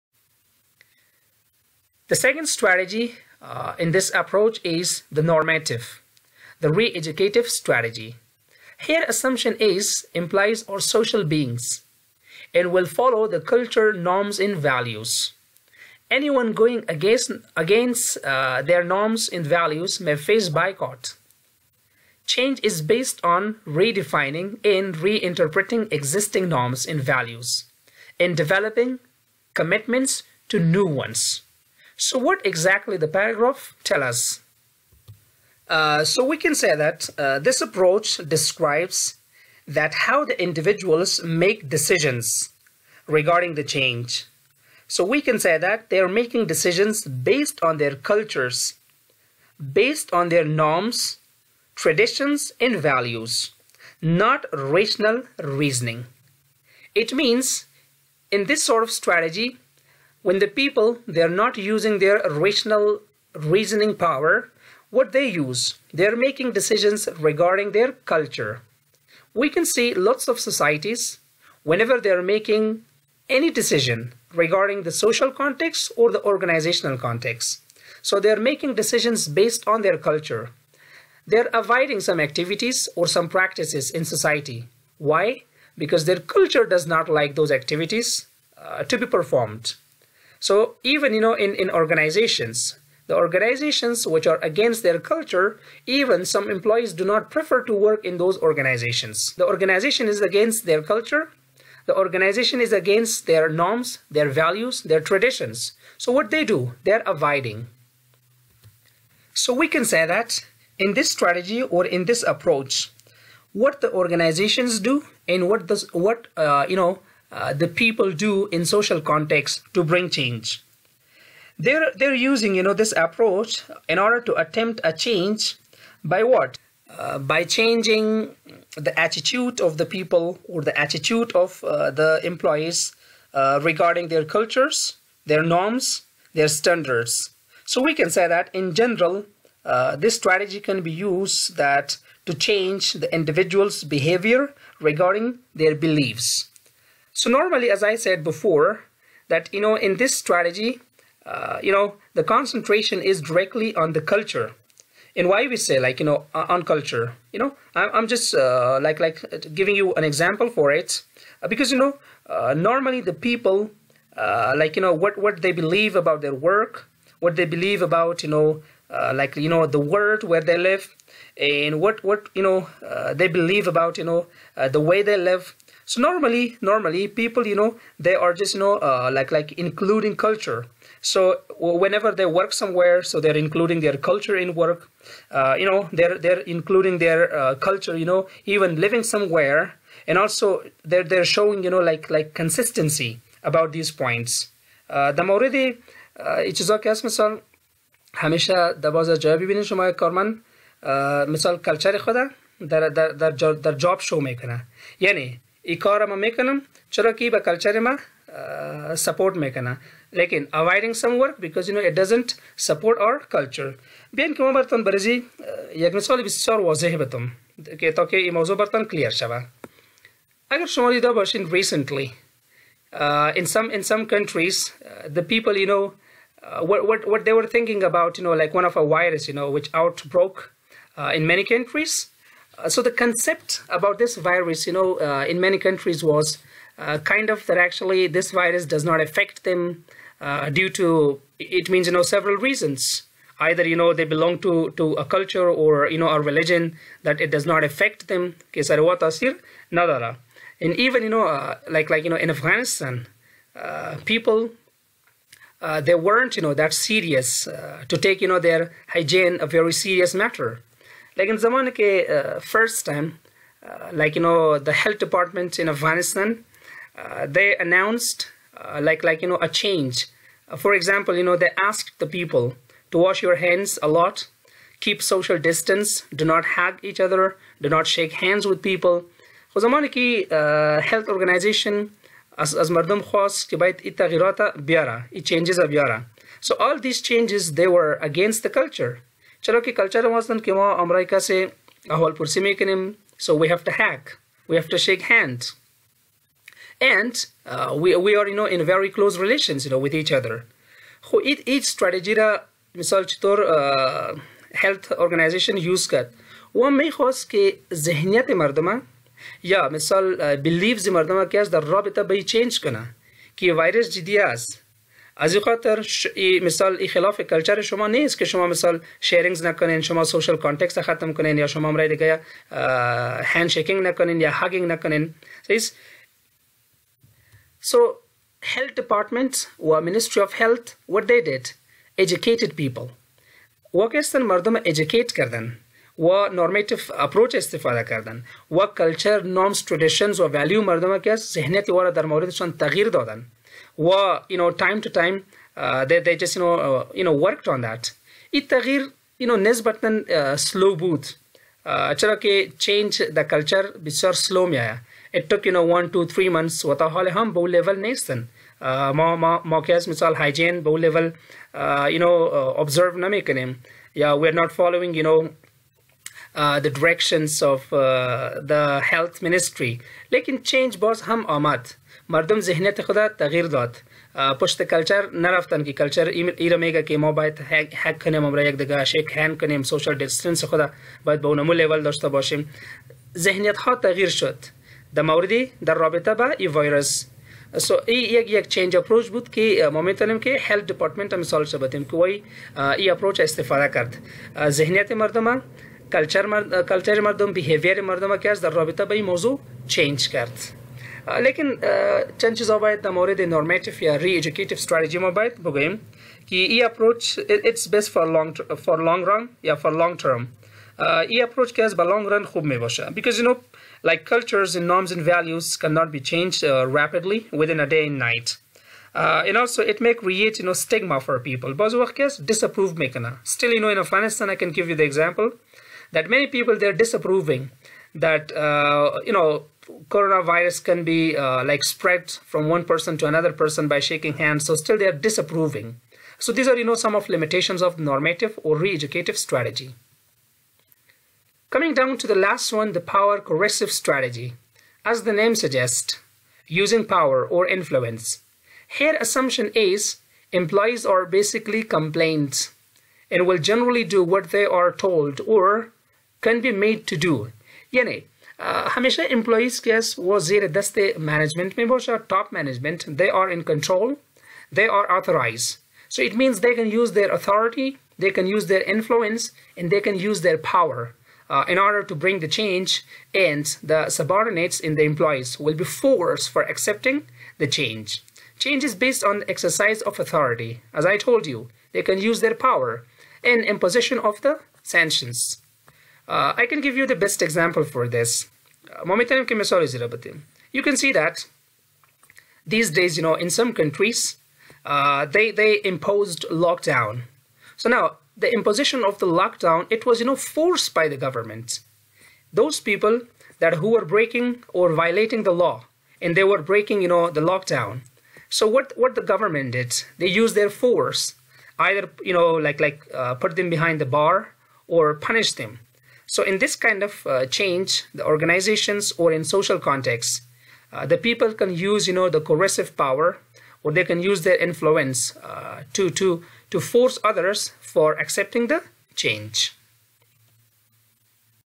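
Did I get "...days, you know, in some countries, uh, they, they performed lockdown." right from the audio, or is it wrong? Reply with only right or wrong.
wrong.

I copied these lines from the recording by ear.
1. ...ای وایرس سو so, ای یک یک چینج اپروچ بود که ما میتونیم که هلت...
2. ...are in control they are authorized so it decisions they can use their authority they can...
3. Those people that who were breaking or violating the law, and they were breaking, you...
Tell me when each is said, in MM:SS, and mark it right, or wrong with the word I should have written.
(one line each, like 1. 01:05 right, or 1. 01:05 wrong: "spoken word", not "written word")
1. 06:26 right
2. 07:43 wrong: "means", not "decisions"
3. 08:22 right.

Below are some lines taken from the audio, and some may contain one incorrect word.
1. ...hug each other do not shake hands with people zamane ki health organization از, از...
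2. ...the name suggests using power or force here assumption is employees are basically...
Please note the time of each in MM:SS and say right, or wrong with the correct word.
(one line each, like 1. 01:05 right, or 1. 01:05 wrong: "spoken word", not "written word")
1. 04:36 right
2. 07:25 wrong: "influence", not "force".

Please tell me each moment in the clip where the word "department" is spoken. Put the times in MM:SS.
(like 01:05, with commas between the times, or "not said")
04:24, 05:28.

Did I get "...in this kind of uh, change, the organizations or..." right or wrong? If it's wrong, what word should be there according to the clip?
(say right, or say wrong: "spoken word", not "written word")
right.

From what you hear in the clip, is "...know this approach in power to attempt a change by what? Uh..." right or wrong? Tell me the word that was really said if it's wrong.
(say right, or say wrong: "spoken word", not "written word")
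wrong: "order", not "power".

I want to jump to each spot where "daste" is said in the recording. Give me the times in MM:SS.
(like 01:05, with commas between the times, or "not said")
07:40.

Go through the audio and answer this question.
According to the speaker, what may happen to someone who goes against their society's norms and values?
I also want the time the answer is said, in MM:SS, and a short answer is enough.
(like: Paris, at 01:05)
Boycott, at 00:20.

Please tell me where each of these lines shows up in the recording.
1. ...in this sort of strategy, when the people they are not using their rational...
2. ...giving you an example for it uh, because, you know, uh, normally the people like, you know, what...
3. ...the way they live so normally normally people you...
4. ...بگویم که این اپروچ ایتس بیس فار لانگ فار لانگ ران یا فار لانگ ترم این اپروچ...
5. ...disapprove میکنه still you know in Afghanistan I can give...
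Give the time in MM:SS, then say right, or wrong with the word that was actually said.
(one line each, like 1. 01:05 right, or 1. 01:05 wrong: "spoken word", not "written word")
1. 00:58 right
2. 02:39 right
3. 02:54 right
4. 06:45 right
5. 07:02 right.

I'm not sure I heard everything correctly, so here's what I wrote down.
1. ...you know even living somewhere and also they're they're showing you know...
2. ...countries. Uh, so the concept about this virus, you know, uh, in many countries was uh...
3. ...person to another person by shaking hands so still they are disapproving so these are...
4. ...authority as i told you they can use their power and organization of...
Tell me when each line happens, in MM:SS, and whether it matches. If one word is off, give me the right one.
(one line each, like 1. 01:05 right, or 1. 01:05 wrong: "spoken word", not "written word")
1. 03:07 right
2. 03:51 right
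3. 07:12 right
4. 08:00 wrong: "imposition", not "organization".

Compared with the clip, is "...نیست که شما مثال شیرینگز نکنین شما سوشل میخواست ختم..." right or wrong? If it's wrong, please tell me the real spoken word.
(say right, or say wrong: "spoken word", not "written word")
wrong: "کانتکست", not "میخواست".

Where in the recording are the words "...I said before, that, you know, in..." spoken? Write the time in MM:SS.
02:27.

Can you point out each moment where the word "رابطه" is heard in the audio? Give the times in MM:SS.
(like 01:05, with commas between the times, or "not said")
06:25, 06:38.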